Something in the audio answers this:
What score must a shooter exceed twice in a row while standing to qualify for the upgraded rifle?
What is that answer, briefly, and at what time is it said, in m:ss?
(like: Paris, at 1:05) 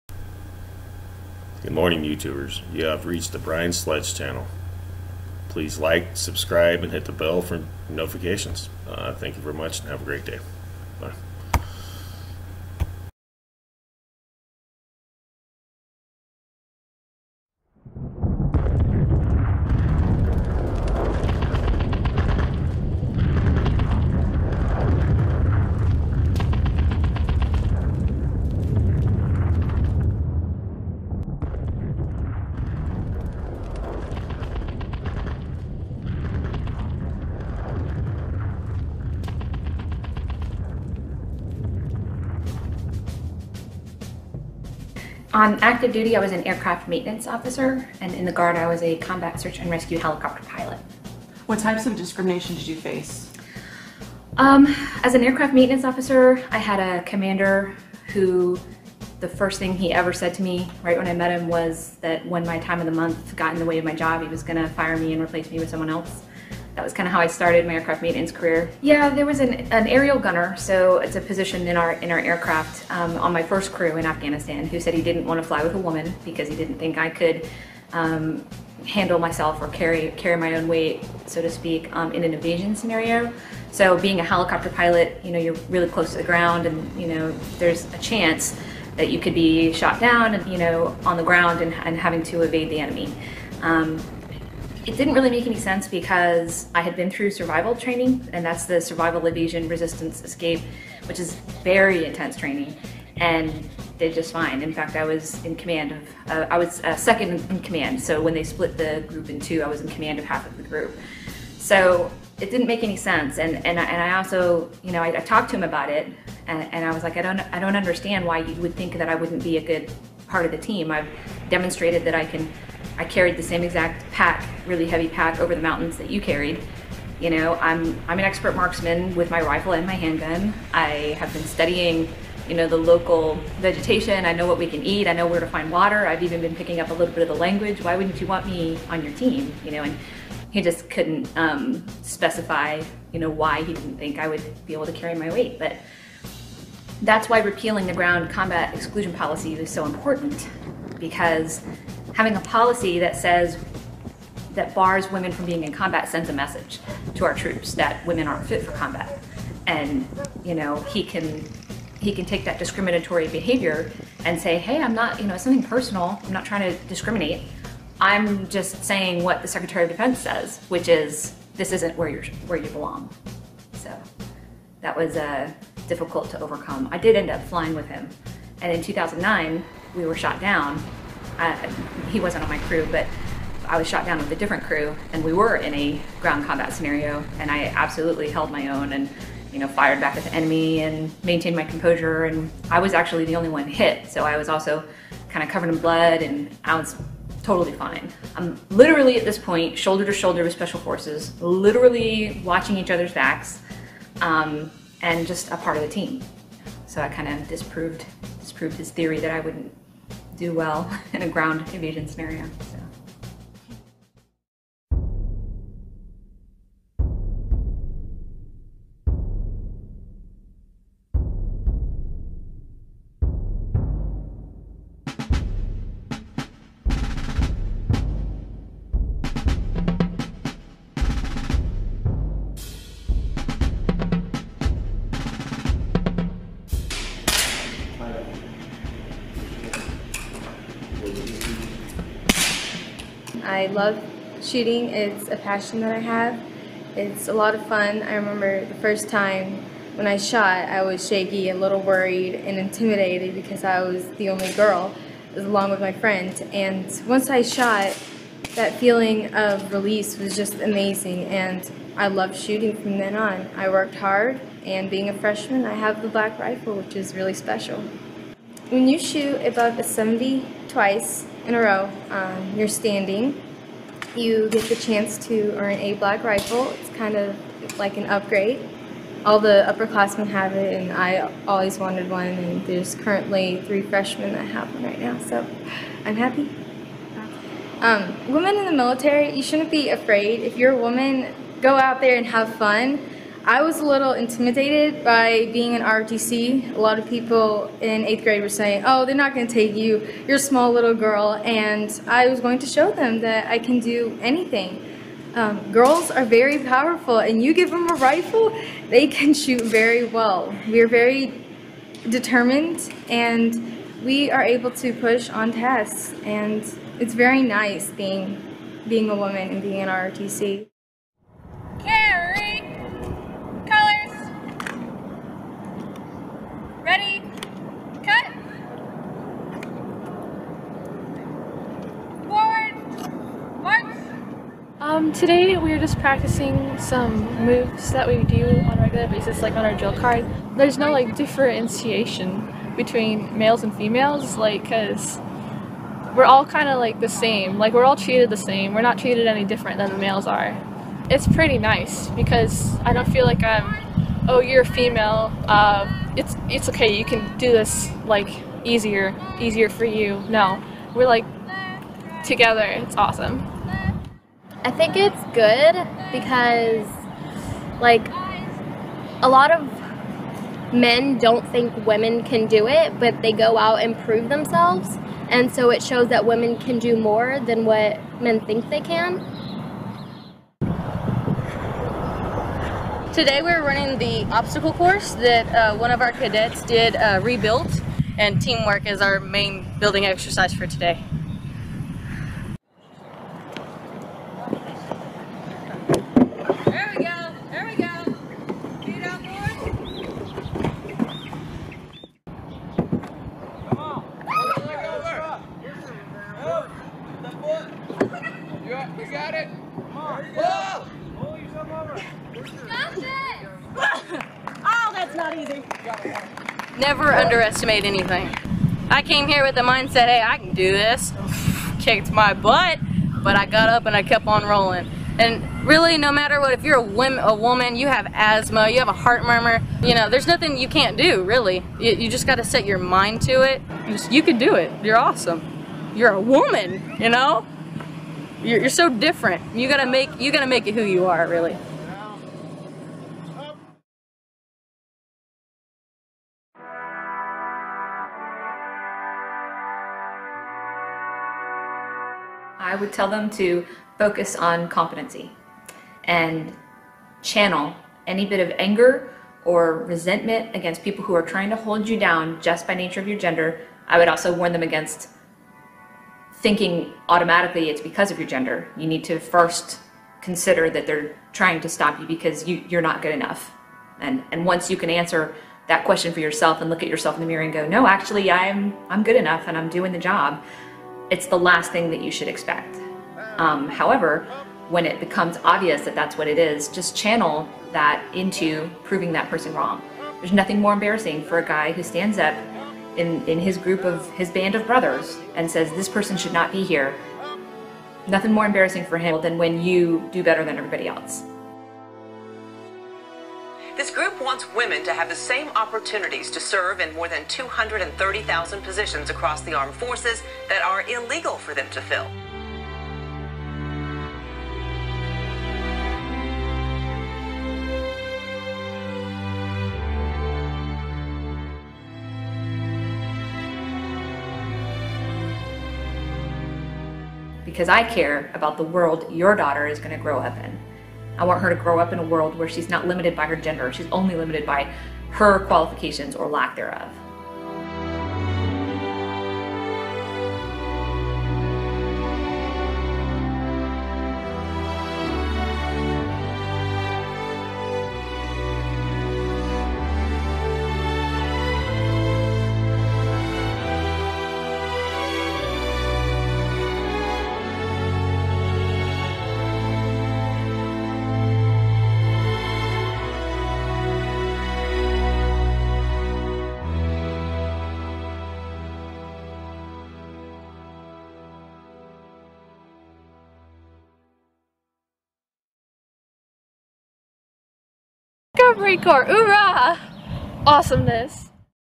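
70, at 4:29.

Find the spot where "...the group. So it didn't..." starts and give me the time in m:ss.
1:50.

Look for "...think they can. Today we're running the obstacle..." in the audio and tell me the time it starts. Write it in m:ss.
6:18.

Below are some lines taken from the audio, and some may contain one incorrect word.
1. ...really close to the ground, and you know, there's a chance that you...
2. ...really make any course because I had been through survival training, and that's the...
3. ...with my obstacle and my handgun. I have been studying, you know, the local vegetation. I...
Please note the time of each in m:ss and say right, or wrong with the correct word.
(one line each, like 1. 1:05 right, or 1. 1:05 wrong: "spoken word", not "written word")
1. 1:25 right
2. 1:35 wrong: "sense", not "course"
3. 2:09 wrong: "rifle", not "obstacle".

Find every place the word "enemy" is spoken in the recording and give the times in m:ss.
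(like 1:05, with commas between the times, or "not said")
1:32, 3:10.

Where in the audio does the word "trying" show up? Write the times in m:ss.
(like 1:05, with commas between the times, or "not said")
2:46, 7:41, 7:51.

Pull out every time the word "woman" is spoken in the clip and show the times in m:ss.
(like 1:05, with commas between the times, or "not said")
1:15, 4:50, 5:19, 7:07, 7:16.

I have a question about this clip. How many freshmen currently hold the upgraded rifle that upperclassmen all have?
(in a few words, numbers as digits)
3.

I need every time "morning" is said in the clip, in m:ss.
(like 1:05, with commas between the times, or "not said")
0:01.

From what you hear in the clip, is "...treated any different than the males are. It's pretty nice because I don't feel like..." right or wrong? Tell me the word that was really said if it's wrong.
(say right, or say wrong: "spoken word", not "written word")
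right.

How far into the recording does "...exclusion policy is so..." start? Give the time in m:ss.
2:28.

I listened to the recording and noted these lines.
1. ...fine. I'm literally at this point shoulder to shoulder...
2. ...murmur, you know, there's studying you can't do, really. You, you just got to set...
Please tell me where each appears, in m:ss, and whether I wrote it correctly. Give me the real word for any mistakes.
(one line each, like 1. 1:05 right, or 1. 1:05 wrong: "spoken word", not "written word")
1. 3:17 right
2. 7:09 wrong: "nothing", not "studying".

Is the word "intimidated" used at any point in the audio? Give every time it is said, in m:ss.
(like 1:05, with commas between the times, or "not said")
4:12, 4:54.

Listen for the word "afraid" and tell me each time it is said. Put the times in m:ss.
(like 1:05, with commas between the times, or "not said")
4:49.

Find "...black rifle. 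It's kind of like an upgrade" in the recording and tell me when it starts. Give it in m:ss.
4:35.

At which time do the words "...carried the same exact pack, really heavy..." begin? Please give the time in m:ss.
2:03.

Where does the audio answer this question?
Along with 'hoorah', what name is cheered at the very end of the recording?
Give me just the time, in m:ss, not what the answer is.
9:38.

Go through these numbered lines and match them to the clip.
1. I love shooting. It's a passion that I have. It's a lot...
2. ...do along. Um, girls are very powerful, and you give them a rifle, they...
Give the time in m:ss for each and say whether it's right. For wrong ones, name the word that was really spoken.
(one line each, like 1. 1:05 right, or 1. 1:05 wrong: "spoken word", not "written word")
1. 4:03 right
2. 5:03 wrong: "anything", not "along".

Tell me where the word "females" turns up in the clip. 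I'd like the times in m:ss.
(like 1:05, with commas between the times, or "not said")
5:43, 5:54.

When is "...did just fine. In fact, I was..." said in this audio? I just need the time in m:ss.
1:43.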